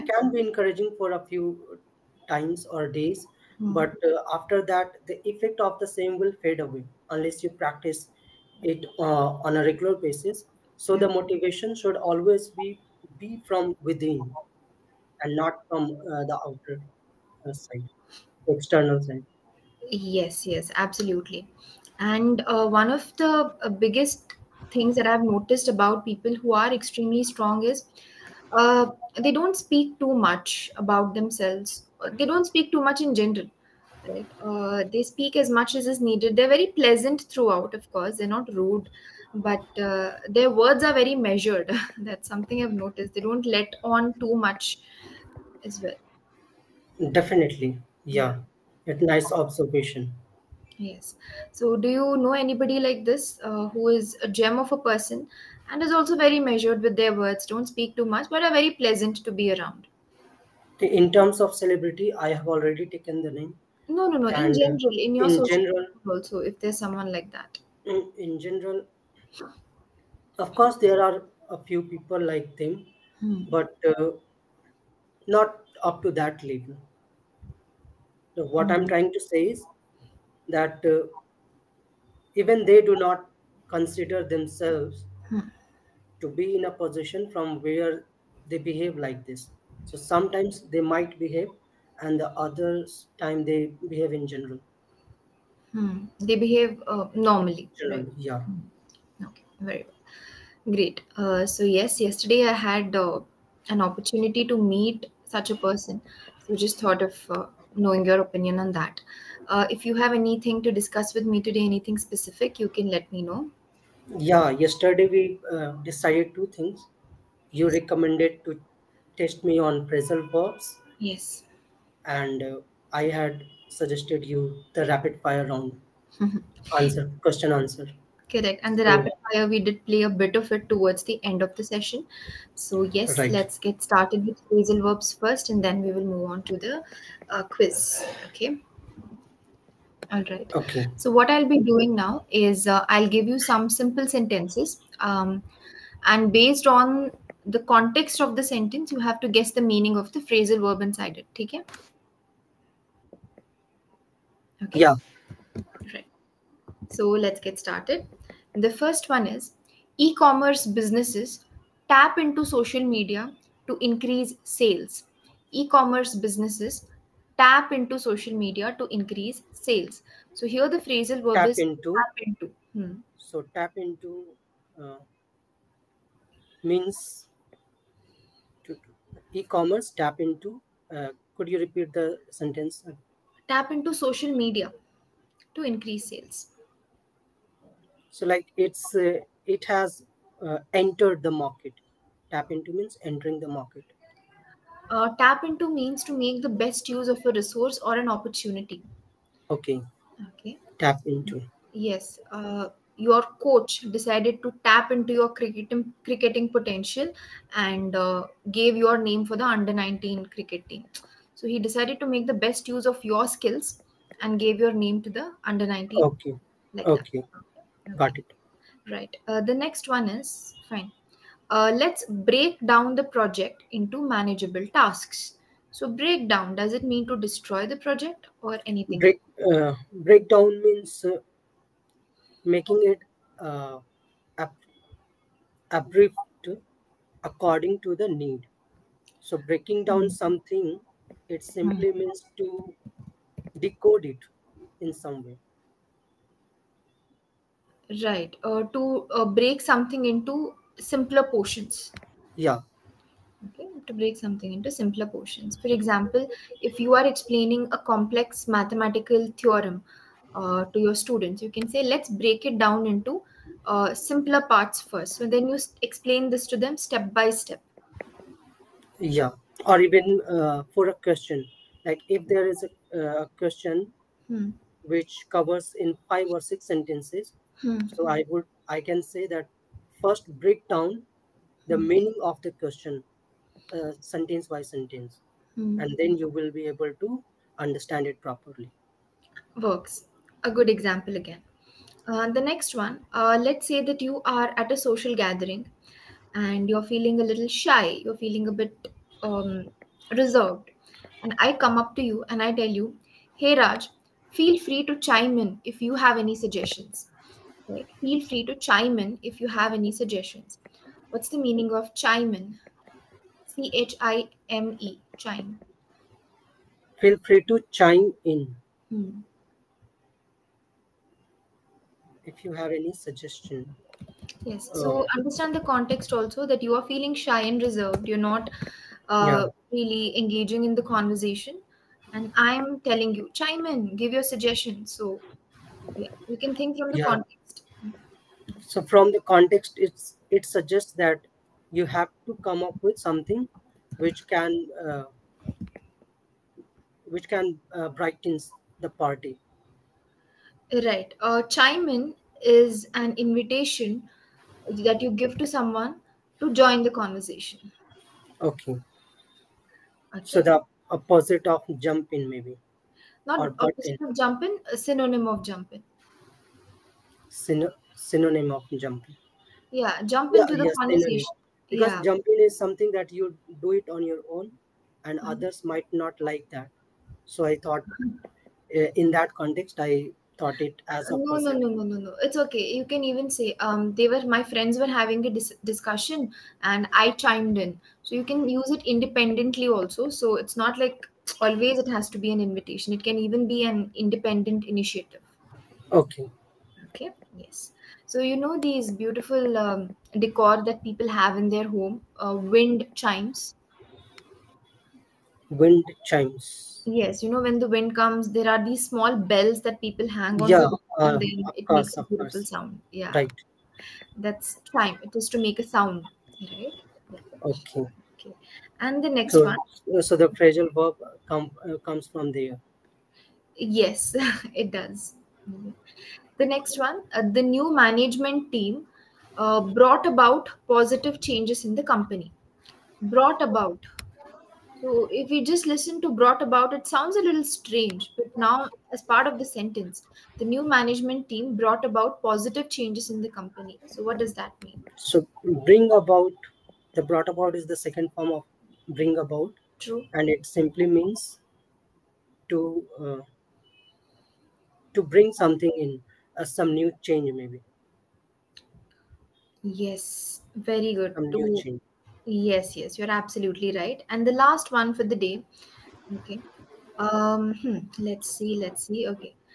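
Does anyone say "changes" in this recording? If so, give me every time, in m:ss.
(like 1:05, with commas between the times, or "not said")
7:11, 7:22, 7:37, 7:41.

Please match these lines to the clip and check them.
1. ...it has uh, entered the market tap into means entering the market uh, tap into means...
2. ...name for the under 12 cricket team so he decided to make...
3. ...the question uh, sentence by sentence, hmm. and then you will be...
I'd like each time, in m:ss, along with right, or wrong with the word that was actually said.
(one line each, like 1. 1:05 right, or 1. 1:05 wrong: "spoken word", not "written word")
1. 3:09 right
2. 3:29 wrong: "19", not "12"
3. 4:42 right.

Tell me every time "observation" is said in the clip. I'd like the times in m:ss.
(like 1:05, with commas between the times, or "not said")
0:49.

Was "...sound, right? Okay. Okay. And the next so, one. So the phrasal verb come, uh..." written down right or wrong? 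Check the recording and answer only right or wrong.
right.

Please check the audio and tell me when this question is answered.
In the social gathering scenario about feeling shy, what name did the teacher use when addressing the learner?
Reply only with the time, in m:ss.
5:03.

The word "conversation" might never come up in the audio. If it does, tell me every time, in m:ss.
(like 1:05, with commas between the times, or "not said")
5:30, 5:56, 6:10.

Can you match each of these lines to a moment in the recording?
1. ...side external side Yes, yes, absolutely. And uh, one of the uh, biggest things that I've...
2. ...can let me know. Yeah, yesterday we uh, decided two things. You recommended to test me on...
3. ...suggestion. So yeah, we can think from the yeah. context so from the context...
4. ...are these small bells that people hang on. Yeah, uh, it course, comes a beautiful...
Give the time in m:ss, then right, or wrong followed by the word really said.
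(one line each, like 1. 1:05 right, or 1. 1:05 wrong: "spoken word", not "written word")
1. 0:17 right
2. 1:52 right
3. 5:34 right
4. 6:48 wrong: "makes", not "comes".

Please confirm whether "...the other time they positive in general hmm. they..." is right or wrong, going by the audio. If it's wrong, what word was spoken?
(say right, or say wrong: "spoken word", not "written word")
wrong: "behave", not "positive".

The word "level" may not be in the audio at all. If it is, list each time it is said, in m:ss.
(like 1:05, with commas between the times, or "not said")
1:16.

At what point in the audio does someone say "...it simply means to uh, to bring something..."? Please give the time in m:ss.
7:30.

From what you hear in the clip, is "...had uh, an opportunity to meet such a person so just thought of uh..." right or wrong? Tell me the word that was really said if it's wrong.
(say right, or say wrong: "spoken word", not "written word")
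right.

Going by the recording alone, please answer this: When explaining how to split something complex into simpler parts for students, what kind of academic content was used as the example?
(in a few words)
Mathematical theorem.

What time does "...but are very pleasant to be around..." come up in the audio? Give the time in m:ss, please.
0:58.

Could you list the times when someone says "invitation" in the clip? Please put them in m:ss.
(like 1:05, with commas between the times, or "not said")
5:53, 6:32.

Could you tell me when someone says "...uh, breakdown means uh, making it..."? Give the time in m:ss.
3:49.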